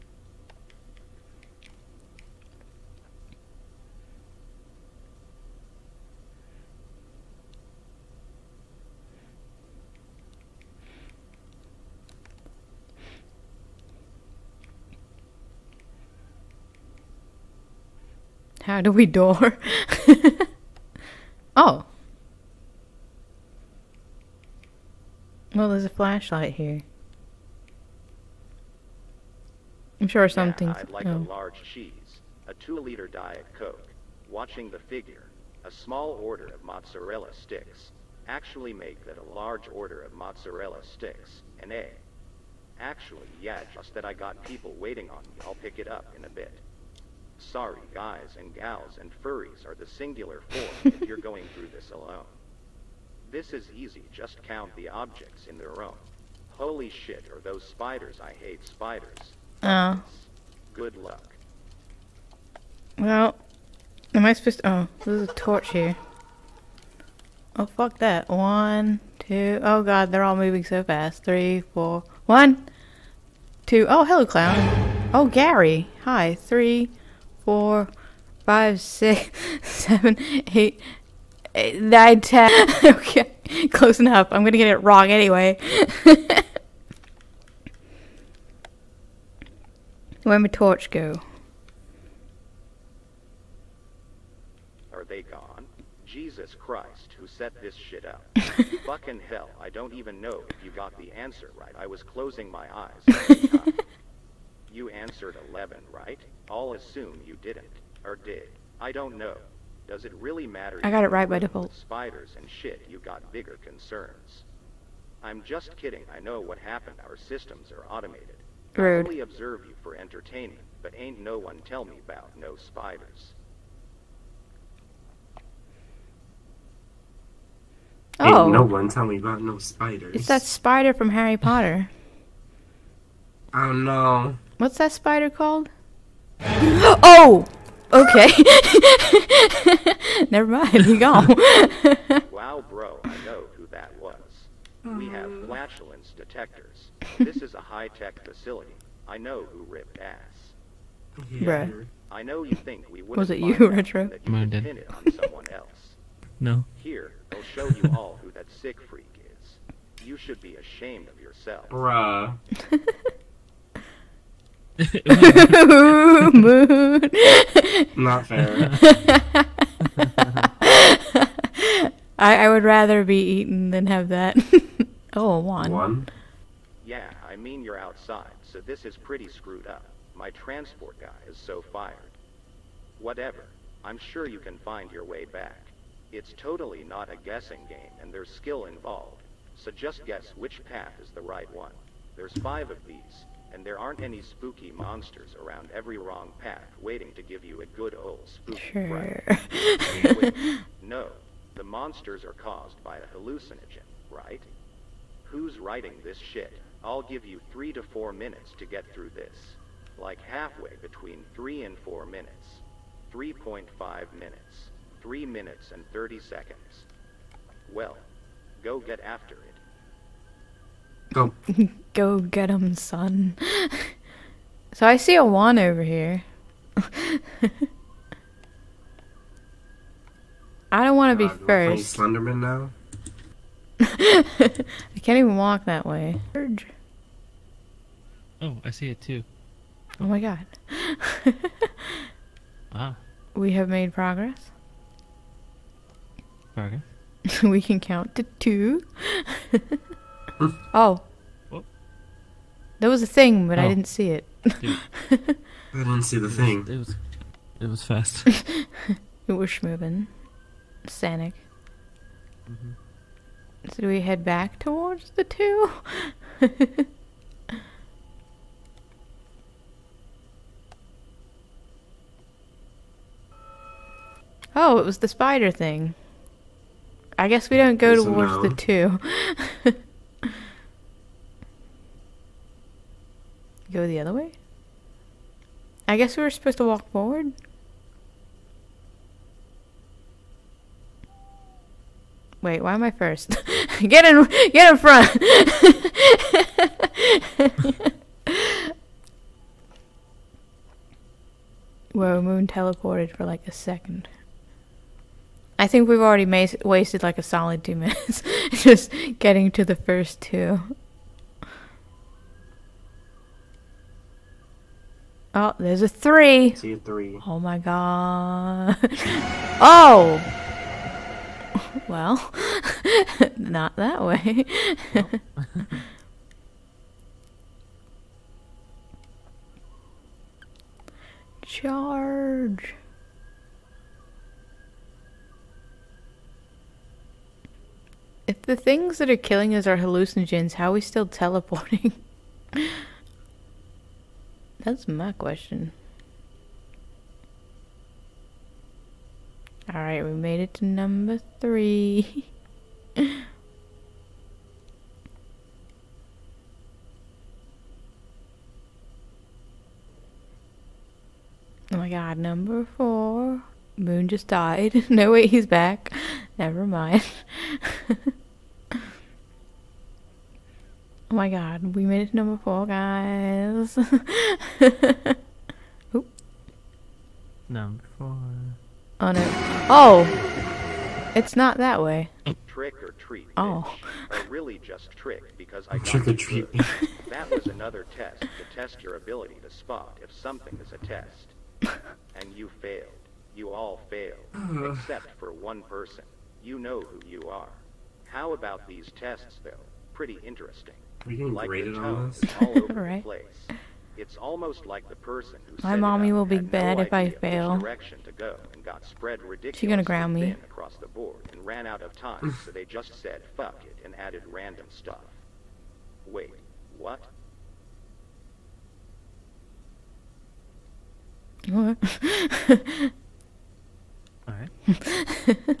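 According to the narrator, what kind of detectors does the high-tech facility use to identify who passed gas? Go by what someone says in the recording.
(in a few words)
flatulence detectors.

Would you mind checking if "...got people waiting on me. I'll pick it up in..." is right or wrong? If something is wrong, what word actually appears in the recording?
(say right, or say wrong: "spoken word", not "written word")
right.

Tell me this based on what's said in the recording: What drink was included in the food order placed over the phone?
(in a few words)
two-liter Diet Coke.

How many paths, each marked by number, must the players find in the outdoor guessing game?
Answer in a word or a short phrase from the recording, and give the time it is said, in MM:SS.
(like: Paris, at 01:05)
5, at 03:12.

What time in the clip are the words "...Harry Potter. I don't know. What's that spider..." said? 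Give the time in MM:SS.
02:11.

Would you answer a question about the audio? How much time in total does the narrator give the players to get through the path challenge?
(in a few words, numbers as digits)
3.5 minutes.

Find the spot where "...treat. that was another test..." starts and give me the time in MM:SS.
06:26.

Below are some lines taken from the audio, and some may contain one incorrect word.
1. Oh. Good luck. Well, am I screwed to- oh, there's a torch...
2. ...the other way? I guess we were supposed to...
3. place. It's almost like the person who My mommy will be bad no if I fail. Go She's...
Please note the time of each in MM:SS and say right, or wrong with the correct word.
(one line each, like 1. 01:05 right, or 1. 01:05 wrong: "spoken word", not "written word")
1. 00:59 wrong: "supposed", not "screwed"
2. 04:43 right
3. 06:43 right.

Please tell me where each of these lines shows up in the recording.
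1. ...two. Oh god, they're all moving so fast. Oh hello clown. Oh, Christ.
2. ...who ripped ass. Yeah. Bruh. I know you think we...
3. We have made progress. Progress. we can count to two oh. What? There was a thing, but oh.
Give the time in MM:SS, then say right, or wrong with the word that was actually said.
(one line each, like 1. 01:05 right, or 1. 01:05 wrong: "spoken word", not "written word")
1. 01:09 wrong: "Gary", not "Christ"
2. 02:29 right
3. 04:03 right.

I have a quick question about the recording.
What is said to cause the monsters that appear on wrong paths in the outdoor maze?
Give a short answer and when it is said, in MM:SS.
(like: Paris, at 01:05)
a hallucinogen, at 03:22.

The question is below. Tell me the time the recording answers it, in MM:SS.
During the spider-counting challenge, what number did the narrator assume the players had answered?
01:44.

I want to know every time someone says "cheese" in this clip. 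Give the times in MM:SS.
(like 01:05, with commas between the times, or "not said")
00:31.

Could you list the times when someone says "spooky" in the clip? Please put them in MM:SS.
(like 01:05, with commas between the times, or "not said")
03:14, 03:18.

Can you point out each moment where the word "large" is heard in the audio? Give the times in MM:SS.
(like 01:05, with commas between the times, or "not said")
00:31, 00:39.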